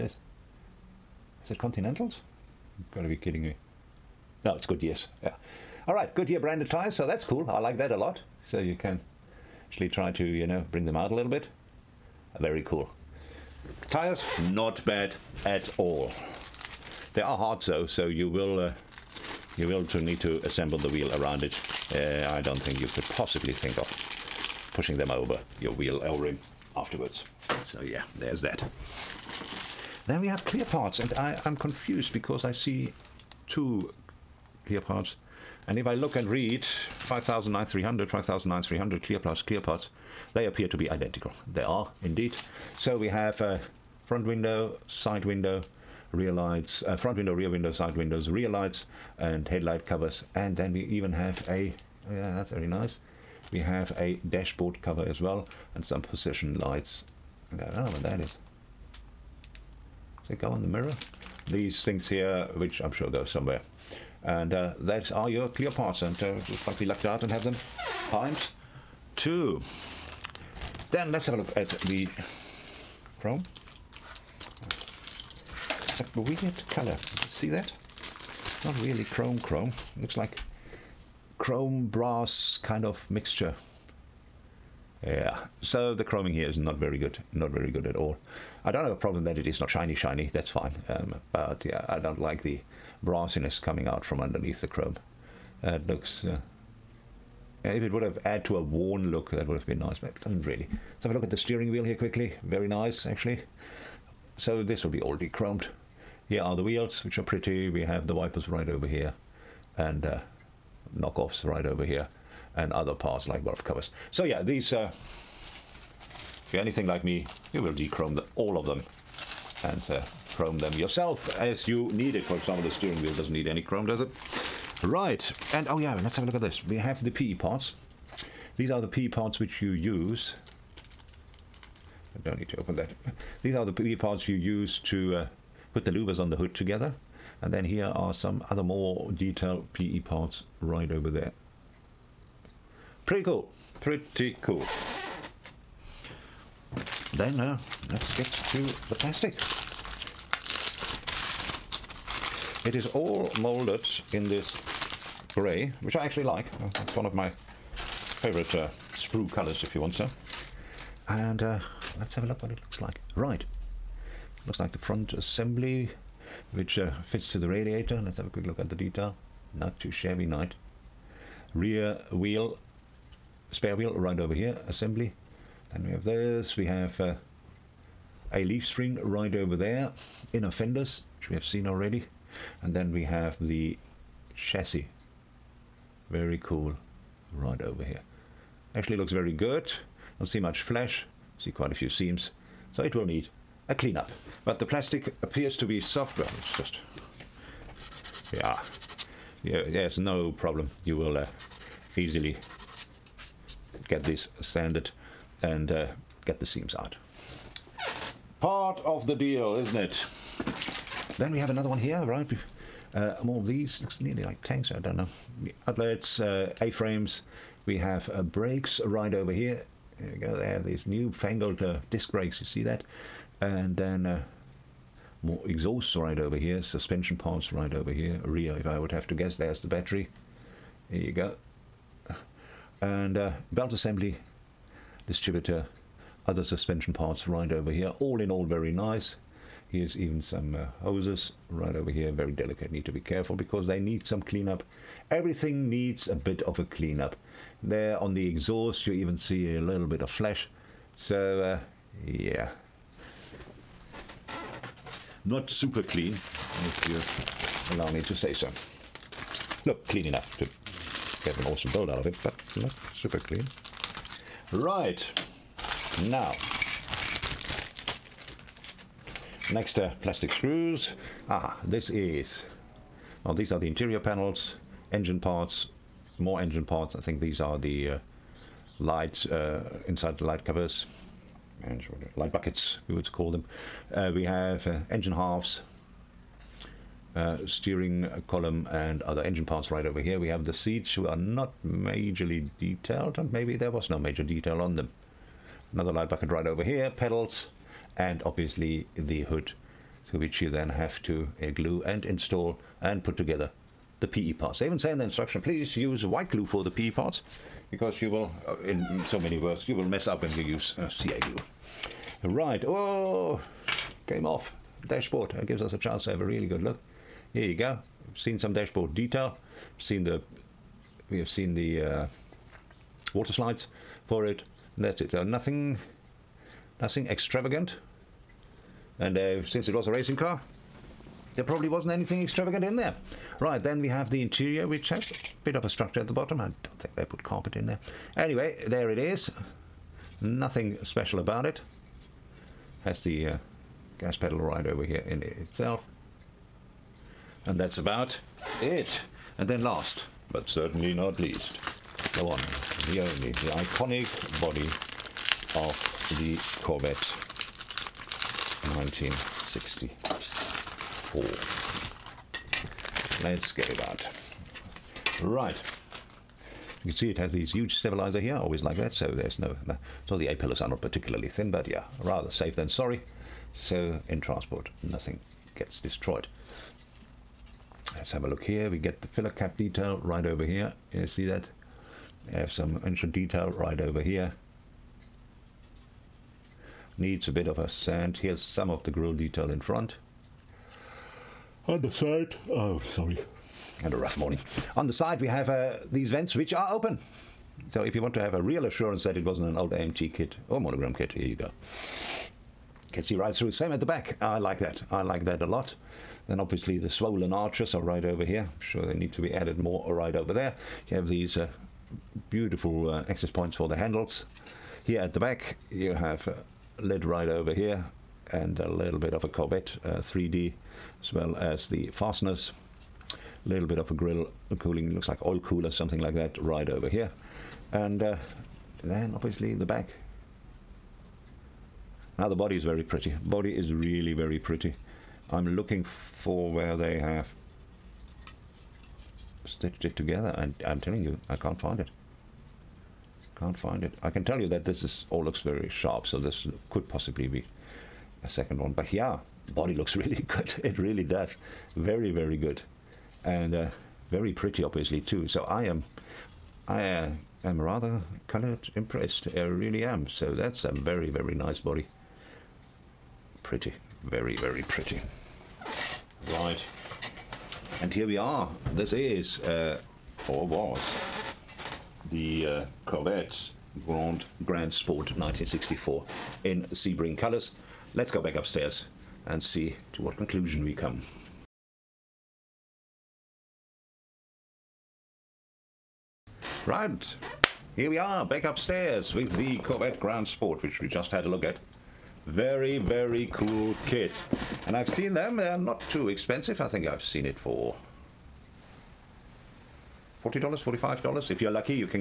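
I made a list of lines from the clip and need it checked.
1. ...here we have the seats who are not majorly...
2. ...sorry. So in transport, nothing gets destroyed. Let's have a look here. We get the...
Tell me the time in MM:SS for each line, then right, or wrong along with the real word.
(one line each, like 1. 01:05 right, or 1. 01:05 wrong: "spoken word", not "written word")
1. 04:49 right
2. 06:12 right.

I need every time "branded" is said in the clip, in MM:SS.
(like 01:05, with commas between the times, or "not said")
00:06.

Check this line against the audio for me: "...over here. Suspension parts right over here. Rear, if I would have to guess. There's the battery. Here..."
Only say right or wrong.
right.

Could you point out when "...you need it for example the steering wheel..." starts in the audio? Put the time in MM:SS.
02:01.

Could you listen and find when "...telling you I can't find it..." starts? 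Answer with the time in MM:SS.
07:20.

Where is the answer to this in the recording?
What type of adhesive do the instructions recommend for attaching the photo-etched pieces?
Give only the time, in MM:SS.
05:06.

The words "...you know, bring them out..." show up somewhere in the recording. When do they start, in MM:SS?
00:10.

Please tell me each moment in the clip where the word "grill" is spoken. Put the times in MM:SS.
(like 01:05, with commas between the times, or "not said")
06:28, 07:03.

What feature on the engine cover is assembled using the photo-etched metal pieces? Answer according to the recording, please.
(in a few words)
louvers.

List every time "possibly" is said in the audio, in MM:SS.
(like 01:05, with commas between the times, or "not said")
00:23, 07:26.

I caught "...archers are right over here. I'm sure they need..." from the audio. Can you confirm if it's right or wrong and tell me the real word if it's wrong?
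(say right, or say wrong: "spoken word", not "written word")
right.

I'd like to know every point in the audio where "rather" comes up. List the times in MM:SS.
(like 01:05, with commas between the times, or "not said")
06:12, 07:37.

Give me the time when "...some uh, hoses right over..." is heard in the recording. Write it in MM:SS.
04:00.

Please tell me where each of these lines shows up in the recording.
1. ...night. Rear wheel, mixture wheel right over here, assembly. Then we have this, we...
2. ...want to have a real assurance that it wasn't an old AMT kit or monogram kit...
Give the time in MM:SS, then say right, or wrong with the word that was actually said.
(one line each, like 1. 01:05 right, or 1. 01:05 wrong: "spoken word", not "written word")
1. 02:50 wrong: "spare", not "mixture"
2. 06:38 right.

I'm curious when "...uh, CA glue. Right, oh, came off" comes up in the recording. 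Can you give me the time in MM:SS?
05:10.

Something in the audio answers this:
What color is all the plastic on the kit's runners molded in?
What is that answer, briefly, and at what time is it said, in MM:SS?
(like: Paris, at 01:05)
grey, at 02:35.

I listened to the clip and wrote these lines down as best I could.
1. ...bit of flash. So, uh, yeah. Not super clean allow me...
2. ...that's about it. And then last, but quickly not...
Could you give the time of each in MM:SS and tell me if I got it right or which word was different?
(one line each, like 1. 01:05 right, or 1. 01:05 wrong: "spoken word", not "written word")
1. 04:09 right
2. 05:47 wrong: "certainly", not "quickly".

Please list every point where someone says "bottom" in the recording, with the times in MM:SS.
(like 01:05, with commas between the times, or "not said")
05:36.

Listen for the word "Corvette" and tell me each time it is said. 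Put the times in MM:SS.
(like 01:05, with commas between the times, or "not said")
05:56, 06:59, 07:52, 08:09.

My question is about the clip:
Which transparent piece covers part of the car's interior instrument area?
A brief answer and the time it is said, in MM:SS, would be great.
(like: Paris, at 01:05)
dashboard cover, at 00:54.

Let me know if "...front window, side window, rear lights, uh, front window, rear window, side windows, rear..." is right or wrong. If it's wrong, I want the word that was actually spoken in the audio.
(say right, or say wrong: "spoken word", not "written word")
right.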